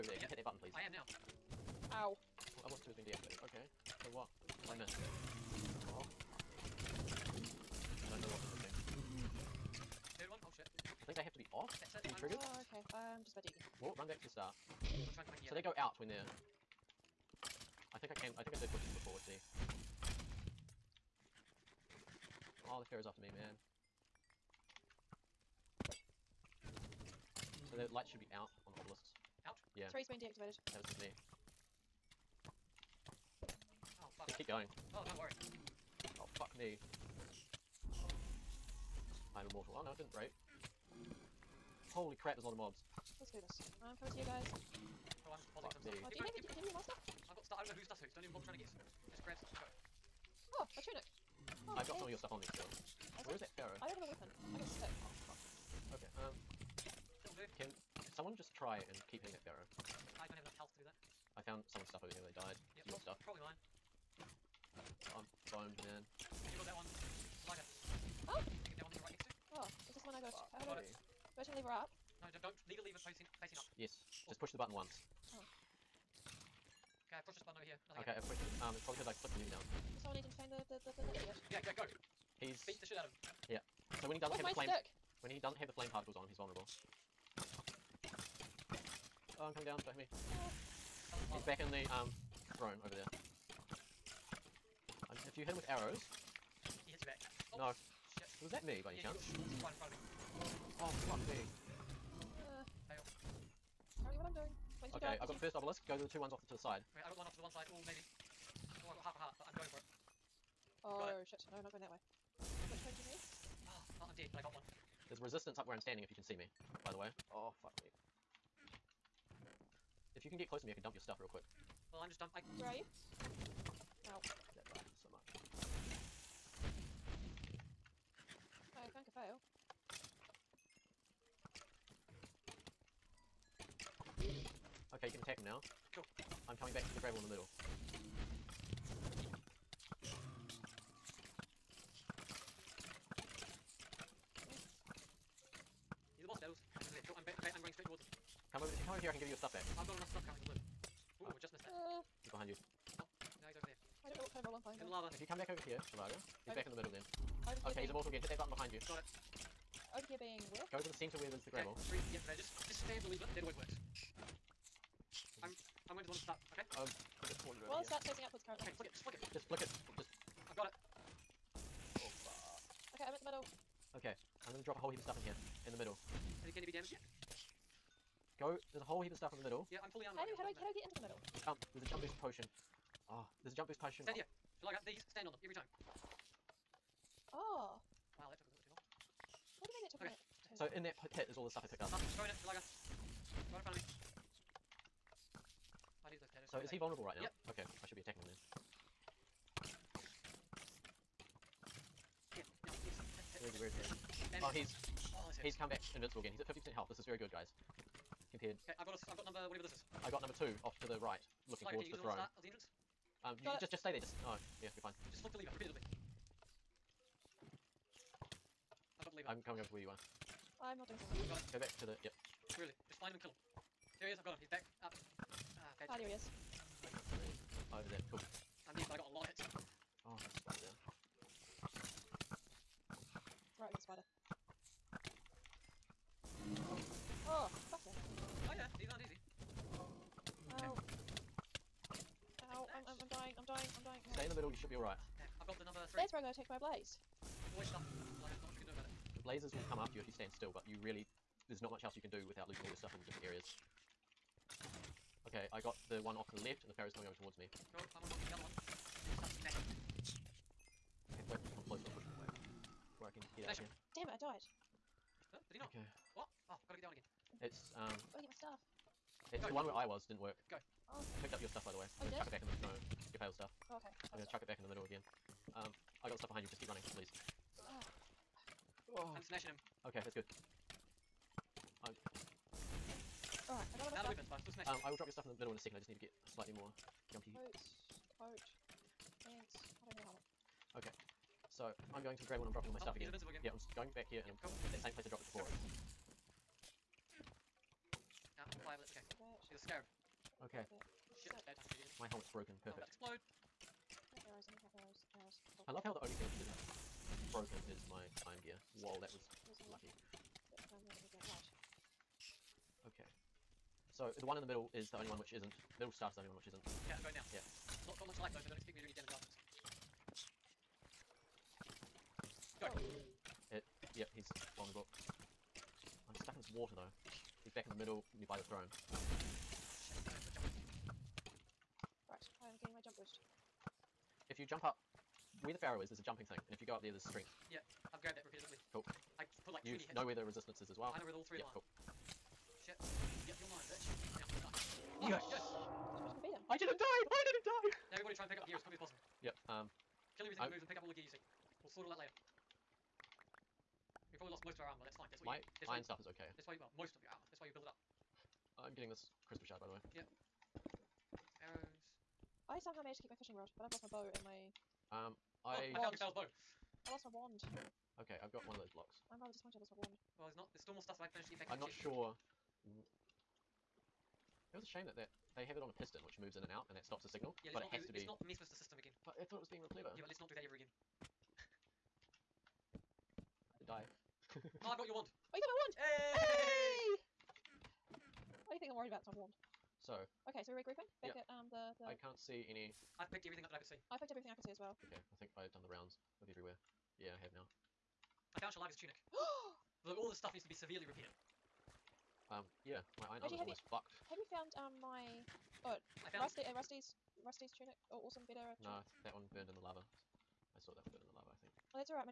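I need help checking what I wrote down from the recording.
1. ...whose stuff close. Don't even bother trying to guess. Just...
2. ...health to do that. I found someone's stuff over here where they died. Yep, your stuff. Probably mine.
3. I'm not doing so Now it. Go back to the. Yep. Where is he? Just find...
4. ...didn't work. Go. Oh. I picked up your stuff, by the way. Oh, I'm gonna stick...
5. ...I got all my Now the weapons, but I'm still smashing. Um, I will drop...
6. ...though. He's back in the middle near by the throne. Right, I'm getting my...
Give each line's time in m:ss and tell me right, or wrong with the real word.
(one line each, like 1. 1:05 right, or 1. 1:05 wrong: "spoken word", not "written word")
1. 0:47 wrong: "whose", not "close"
2. 1:00 right
3. 3:40 wrong: "Got", not "Now"
4. 4:30 wrong: "chuck", not "stick"
5. 4:43 right
6. 5:26 right.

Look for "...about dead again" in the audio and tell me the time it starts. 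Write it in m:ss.
0:13.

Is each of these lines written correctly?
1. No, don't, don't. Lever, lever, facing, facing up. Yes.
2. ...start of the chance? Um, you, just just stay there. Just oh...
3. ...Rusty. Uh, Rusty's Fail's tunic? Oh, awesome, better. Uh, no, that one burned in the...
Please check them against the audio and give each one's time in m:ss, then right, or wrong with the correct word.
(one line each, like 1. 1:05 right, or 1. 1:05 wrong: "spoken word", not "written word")
1. 1:12 right
2. 3:32 wrong: "entrance", not "chance"
3. 6:46 wrong: "Rusty", not "Fail".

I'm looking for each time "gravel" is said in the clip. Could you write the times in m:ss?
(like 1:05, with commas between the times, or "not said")
2:17, 2:41.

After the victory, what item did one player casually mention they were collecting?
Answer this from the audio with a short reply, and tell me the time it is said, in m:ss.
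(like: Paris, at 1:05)
Crystal shard, at 5:58.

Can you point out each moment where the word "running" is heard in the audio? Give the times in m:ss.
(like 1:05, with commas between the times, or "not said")
2:27, 4:36.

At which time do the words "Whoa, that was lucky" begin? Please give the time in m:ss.
5:08.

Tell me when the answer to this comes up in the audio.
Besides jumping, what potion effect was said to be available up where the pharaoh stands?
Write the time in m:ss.
5:36.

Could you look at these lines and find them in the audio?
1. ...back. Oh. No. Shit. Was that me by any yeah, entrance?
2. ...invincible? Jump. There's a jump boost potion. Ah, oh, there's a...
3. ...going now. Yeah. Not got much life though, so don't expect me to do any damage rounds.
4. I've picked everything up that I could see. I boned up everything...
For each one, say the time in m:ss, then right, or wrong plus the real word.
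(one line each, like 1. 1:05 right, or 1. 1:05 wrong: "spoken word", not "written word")
1. 1:37 wrong: "chance", not "entrance"
2. 3:01 wrong: "middle", not "invincible"
3. 5:17 wrong: "afterwards", not "rounds"
4. 6:32 wrong: "picked", not "boned".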